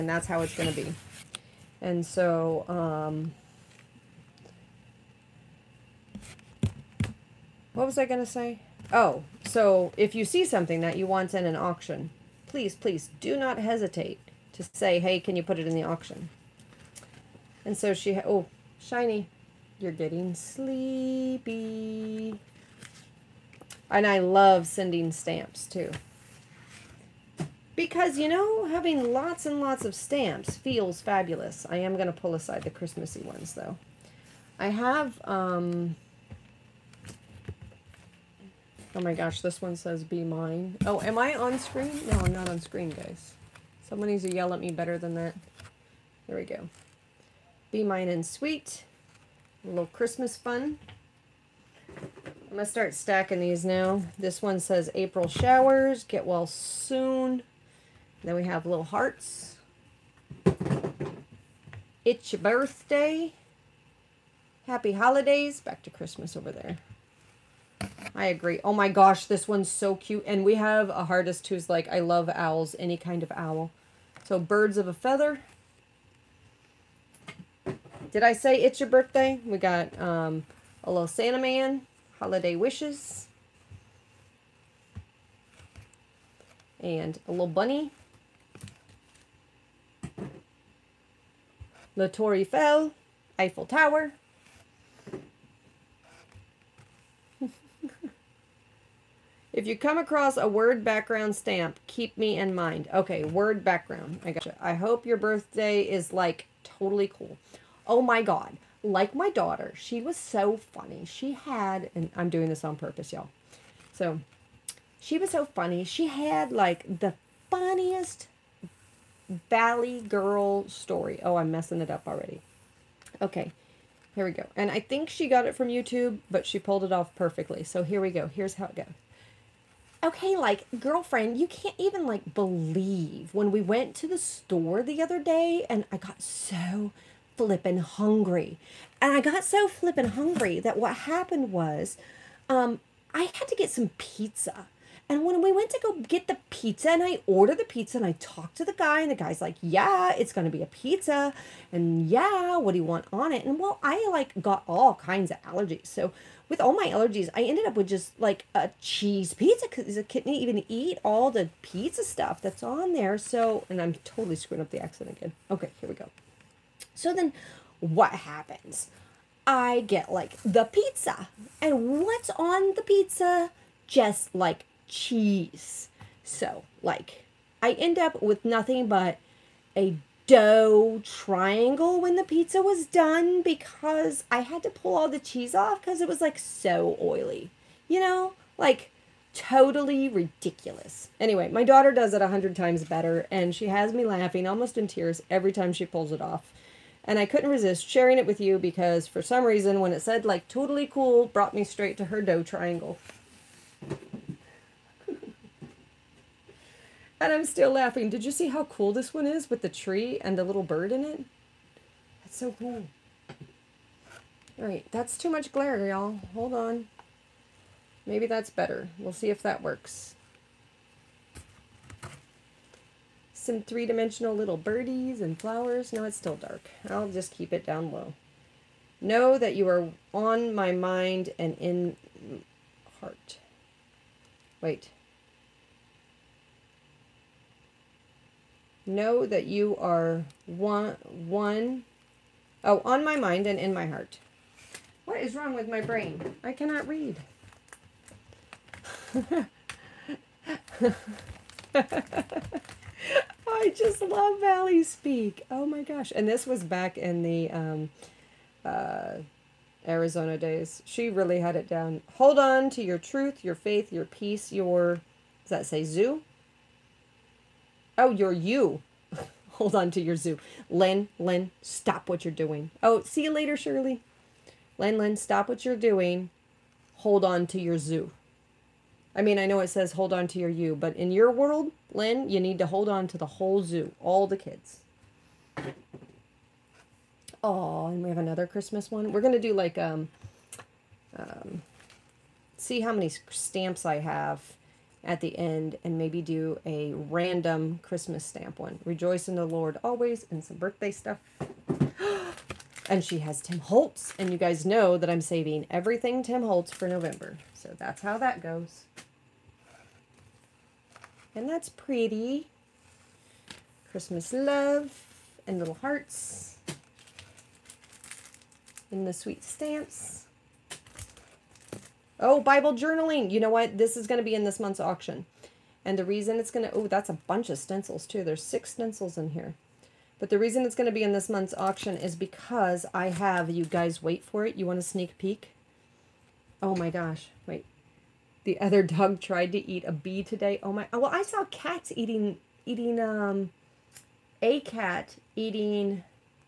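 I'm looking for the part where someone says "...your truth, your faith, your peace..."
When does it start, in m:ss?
4:22.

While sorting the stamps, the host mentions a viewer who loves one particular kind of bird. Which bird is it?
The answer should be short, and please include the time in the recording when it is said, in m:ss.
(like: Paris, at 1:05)
Owls, at 1:12.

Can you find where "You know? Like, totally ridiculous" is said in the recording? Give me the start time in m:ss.
3:07.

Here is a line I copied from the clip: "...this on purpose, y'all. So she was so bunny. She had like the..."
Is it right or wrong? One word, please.
wrong.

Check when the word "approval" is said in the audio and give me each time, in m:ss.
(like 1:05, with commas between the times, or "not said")
not said.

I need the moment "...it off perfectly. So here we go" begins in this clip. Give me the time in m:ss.
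2:06.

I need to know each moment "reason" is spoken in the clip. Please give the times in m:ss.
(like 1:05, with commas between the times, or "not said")
3:19, 5:26, 5:30.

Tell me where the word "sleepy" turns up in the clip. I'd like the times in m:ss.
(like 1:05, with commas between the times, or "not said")
0:20.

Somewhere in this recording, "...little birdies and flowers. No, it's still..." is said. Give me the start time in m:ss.
3:44.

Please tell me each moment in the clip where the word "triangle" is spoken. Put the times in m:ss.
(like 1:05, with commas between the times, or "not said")
3:01, 3:22.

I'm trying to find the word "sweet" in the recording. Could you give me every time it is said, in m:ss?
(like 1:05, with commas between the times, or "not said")
0:48, 5:19.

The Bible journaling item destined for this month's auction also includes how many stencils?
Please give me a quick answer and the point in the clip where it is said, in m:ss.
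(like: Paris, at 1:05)
6, at 5:28.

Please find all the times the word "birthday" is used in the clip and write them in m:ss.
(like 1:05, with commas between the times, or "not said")
1:02, 1:18, 1:45, 5:00.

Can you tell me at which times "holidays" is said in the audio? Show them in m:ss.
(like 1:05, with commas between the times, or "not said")
1:04, 1:22.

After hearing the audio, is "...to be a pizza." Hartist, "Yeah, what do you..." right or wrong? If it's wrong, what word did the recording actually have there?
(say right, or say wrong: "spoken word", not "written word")
wrong: "And", not "Hartist".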